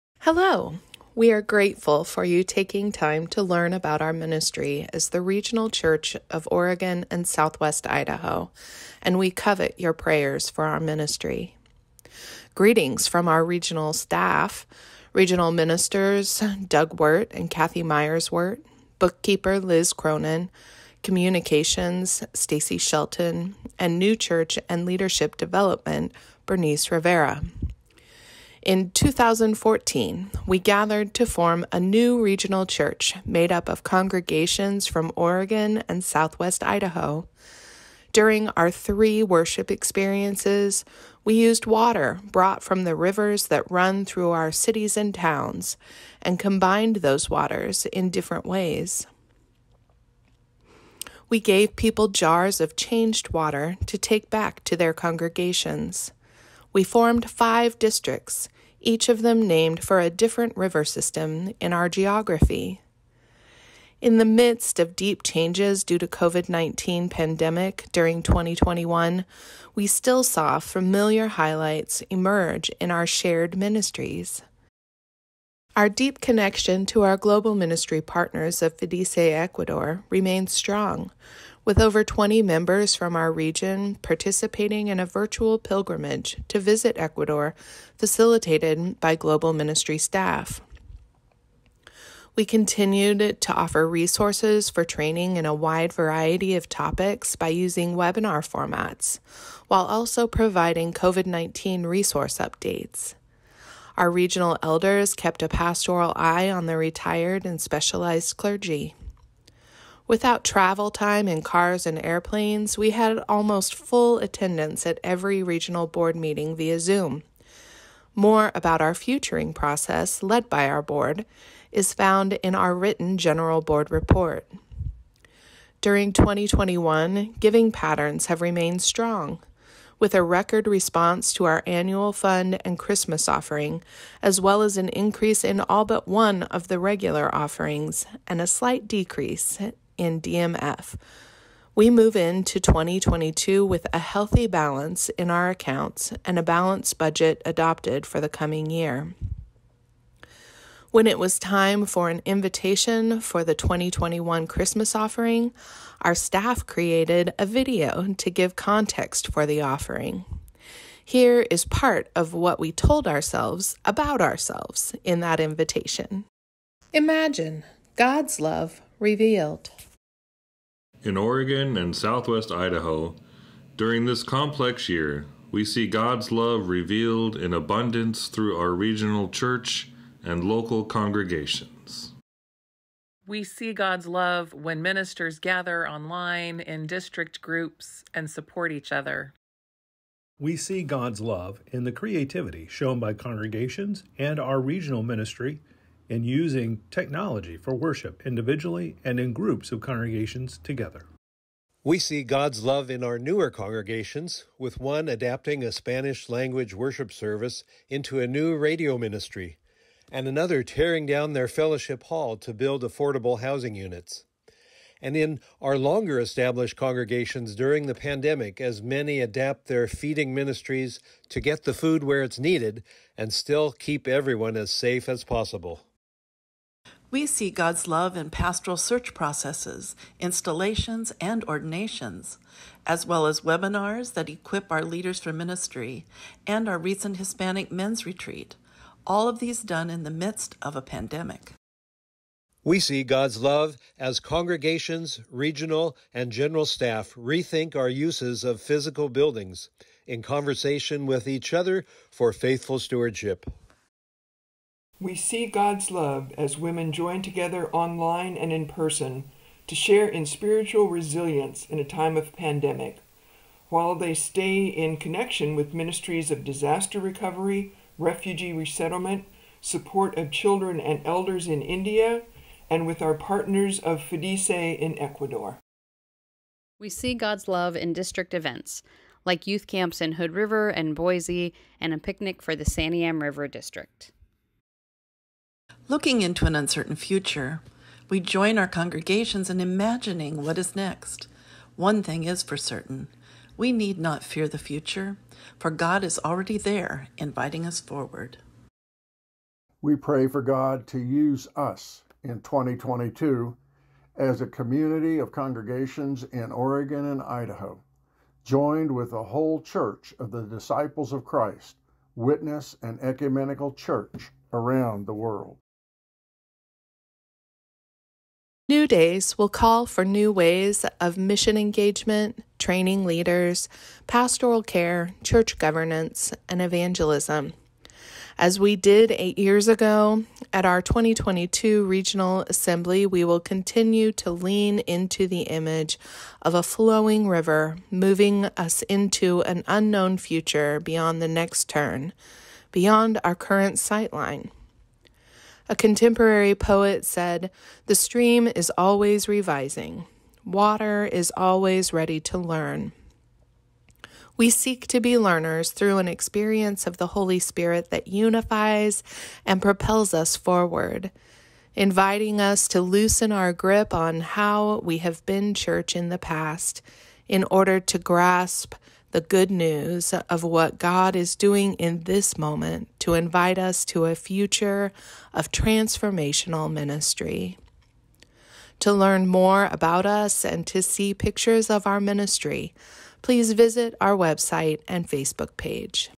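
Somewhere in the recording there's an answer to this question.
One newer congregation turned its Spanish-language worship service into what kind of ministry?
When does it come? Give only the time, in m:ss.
3:28.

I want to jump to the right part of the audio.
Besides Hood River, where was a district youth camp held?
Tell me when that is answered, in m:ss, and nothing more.
4:40.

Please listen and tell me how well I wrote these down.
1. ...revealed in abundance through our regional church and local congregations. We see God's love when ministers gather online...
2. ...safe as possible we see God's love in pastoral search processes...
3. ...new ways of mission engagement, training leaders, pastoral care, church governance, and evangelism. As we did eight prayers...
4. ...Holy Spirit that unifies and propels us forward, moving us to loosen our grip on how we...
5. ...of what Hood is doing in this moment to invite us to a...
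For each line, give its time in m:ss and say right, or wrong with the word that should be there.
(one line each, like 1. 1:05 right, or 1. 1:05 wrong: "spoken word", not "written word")
1. 2:56 right
2. 3:44 right
3. 5:20 wrong: "years", not "prayers"
4. 5:57 wrong: "inviting", not "moving"
5. 6:10 wrong: "God", not "Hood".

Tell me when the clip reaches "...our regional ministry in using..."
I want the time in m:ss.
3:14.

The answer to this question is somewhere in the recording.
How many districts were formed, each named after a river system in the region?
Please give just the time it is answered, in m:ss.
0:57.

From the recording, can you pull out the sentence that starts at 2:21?
We move into 2022 with a healthy balance in our accounts and a balanced budget adopted for the coming year.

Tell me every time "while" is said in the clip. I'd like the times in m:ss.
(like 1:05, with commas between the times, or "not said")
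1:39, 4:23.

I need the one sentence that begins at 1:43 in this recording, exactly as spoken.
Our regional elders kept a pastoral eye on the retired and specialized clergy.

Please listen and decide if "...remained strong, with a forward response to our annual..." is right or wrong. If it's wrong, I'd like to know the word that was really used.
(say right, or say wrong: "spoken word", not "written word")
wrong: "record", not "forward".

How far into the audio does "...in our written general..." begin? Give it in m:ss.
2:02.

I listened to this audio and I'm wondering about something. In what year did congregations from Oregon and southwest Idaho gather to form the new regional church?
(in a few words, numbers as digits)
2014.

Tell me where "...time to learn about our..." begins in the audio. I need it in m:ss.
0:02.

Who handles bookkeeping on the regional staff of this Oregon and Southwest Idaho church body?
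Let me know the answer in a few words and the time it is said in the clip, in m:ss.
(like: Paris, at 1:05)
Liz Cronin, at 0:19.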